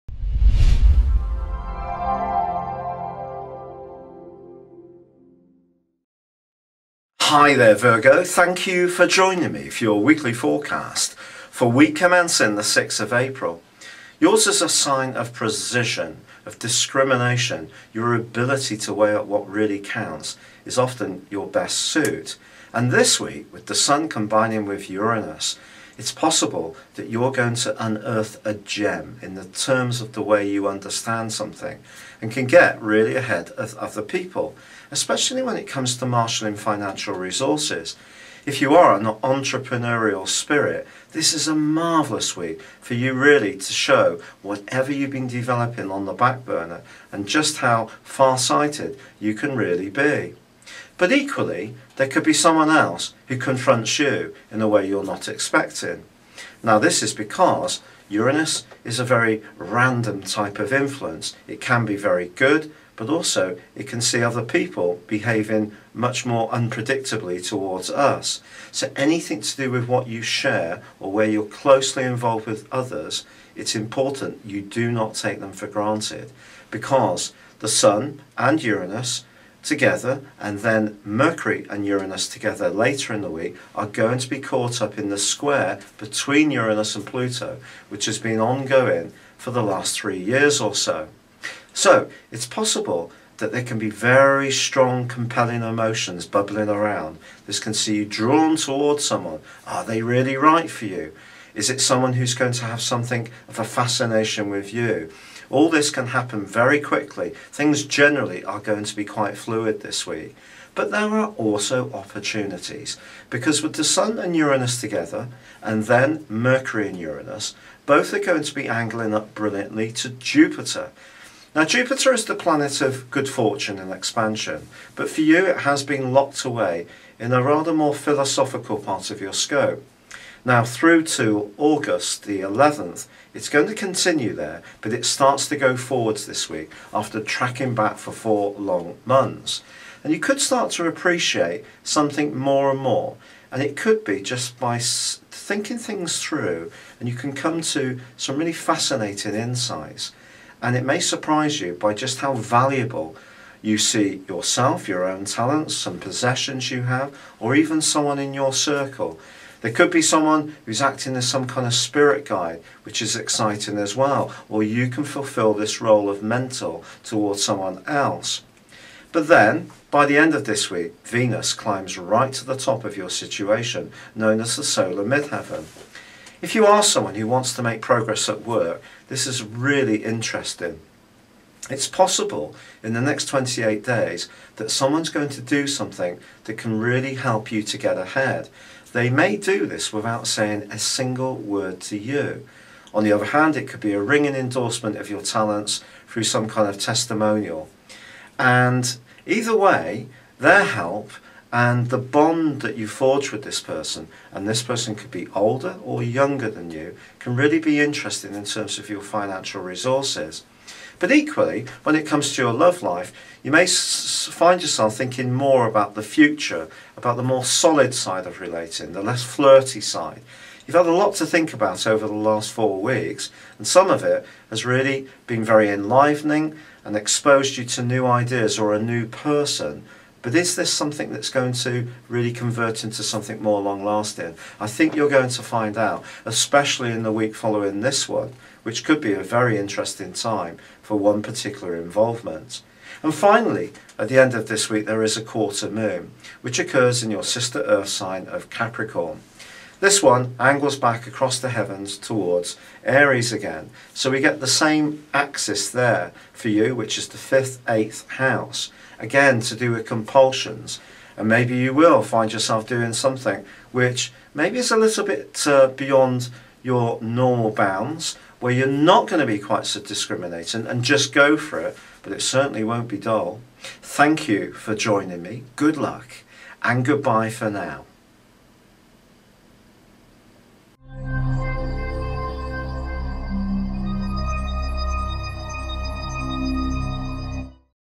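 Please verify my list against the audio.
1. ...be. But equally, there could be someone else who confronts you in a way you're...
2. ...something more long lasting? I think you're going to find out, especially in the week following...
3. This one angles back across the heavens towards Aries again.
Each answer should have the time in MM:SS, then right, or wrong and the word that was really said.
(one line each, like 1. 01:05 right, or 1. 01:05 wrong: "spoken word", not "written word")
1. 00:49 right
2. 03:53 right
3. 04:09 right.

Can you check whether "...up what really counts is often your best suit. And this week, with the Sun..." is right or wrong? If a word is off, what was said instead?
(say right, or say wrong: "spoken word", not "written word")
right.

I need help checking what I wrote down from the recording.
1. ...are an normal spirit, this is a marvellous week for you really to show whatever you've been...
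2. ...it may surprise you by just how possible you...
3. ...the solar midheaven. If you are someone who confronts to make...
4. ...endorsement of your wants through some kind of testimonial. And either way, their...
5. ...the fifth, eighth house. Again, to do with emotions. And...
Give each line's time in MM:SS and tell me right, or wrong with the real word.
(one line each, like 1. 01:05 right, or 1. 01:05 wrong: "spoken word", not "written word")
1. 00:38 wrong: "entrepreneurial", not "normal"
2. 02:30 wrong: "valuable", not "possible"
3. 02:54 wrong: "wants", not "confronts"
4. 03:14 wrong: "talents", not "wants"
5. 04:17 wrong: "compulsions", not "emotions".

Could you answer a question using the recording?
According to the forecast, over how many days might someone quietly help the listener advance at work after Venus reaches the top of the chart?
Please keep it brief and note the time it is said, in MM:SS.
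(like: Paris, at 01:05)
28, at 03:03.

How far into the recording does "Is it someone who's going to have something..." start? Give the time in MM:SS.
01:41.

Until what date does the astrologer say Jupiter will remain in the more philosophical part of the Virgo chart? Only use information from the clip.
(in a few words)
August 11.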